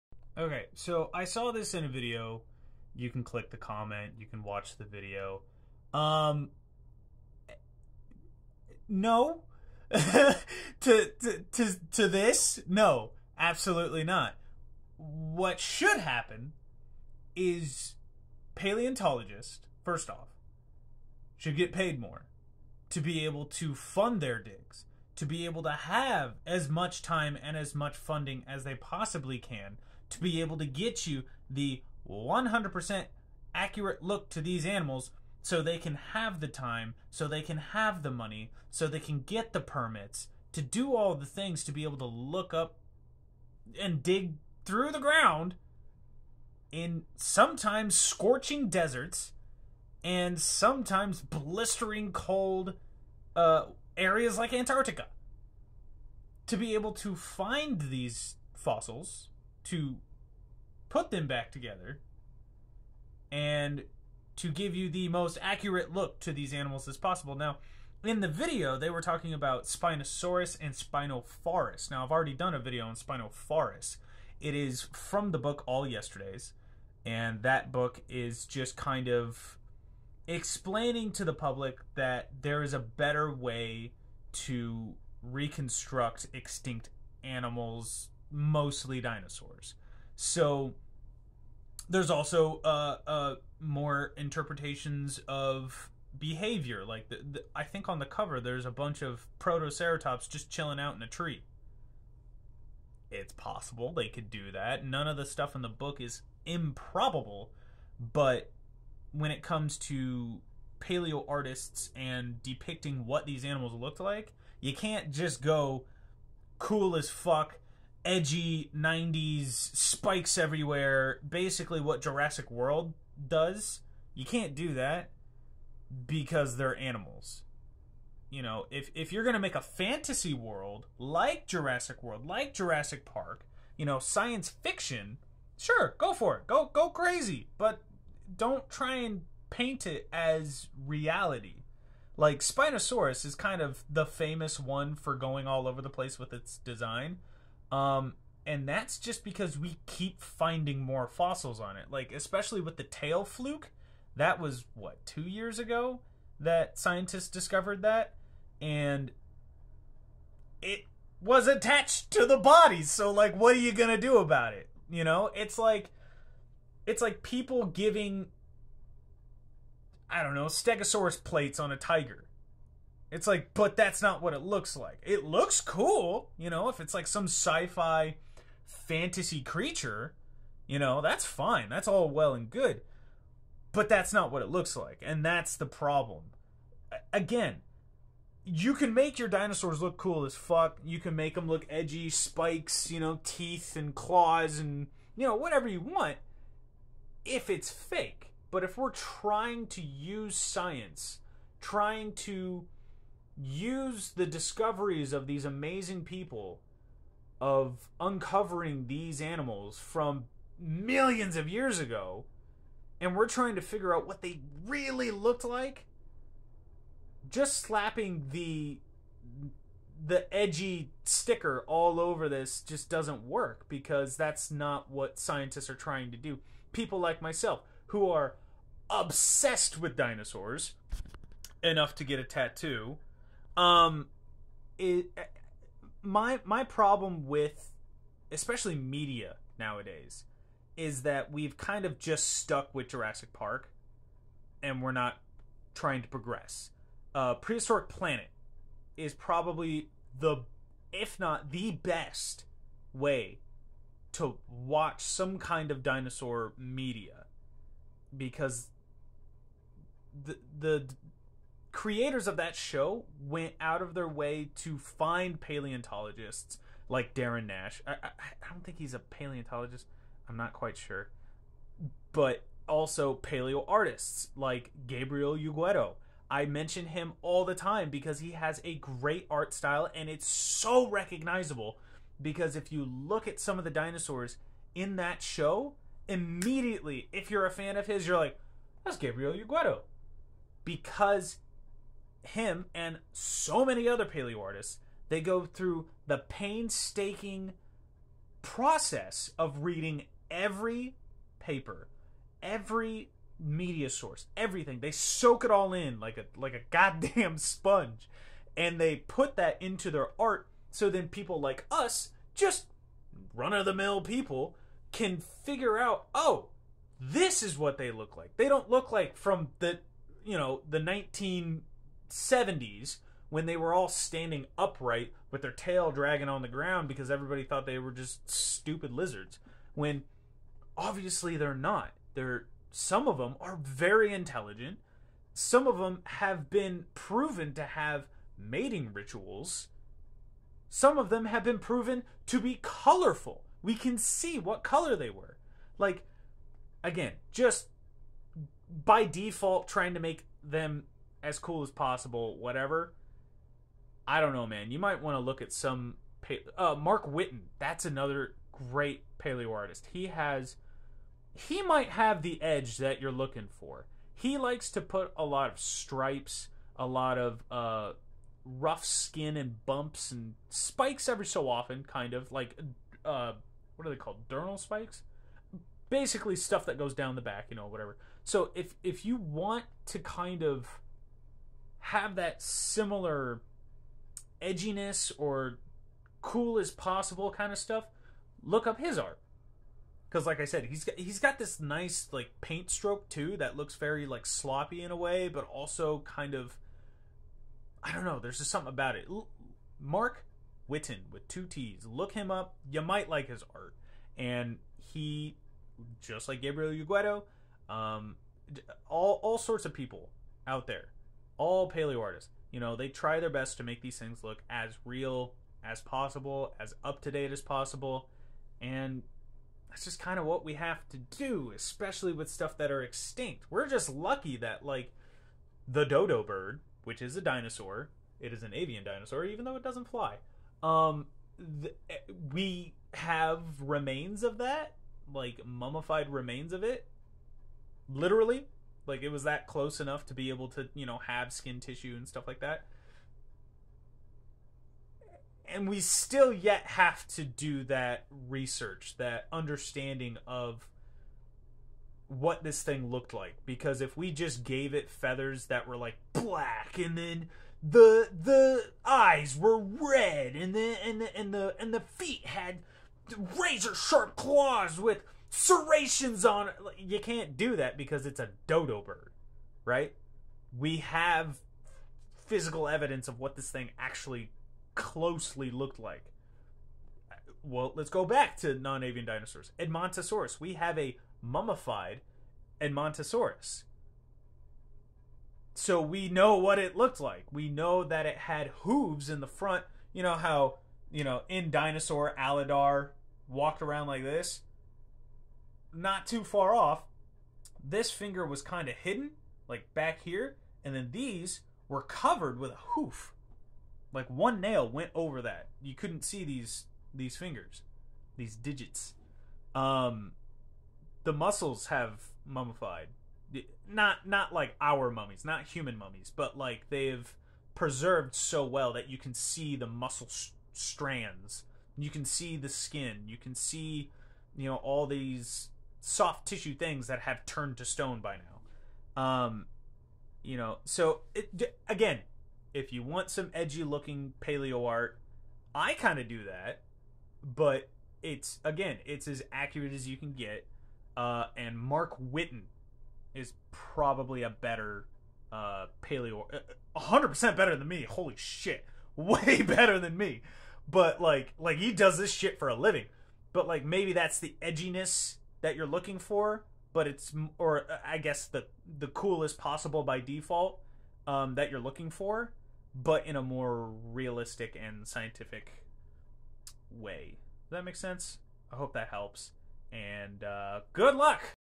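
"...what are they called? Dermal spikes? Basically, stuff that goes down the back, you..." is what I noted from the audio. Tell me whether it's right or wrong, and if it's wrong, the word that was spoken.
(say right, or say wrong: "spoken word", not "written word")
right.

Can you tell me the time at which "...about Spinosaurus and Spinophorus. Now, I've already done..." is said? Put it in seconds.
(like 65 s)
69 s.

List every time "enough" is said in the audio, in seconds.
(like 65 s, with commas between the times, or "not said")
231 s, 439 s.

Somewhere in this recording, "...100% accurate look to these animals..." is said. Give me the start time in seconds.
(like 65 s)
32 s.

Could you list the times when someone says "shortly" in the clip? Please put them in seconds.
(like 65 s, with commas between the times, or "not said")
not said.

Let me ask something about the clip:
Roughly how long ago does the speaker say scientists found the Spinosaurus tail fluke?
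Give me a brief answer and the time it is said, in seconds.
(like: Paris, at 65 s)
2 years, at 155 s.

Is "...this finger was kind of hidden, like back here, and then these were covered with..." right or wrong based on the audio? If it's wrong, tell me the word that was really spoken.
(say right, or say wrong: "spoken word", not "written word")
right.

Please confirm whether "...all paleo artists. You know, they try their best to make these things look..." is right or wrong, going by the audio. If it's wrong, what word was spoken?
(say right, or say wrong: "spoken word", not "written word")
right.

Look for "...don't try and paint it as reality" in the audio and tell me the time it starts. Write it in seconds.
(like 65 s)
138 s.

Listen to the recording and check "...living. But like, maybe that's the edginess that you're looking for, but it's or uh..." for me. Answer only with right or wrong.
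right.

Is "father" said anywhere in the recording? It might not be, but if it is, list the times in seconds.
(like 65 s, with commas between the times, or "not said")
not said.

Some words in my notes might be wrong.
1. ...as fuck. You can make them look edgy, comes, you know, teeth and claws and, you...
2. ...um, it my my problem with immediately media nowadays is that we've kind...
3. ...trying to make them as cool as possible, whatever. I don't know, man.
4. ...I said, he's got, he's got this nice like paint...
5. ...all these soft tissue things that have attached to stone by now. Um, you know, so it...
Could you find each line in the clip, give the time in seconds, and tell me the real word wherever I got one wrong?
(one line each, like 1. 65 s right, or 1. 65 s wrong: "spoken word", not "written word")
1. 190 s wrong: "spikes", not "comes"
2. 233 s wrong: "especially", not "immediately"
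3. 349 s right
4. 390 s right
5. 524 s wrong: "turned", not "attached".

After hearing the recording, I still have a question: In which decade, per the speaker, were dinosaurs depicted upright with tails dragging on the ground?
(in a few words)
1970s.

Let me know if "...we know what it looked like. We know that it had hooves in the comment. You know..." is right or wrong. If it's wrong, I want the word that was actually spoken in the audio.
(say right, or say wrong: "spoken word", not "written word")
wrong: "front", not "comment".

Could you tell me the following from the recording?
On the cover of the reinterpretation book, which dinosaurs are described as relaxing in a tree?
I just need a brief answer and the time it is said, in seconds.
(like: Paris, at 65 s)
Protoceratops, at 99 s.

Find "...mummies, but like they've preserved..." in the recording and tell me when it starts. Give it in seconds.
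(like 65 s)
515 s.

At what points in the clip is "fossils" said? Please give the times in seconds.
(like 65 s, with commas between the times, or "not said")
58 s, 151 s.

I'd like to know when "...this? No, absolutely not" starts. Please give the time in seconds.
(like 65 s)
12 s.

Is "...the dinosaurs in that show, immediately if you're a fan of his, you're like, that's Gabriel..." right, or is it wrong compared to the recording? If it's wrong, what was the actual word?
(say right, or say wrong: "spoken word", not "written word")
right.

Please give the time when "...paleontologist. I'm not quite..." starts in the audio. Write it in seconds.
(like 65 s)
268 s.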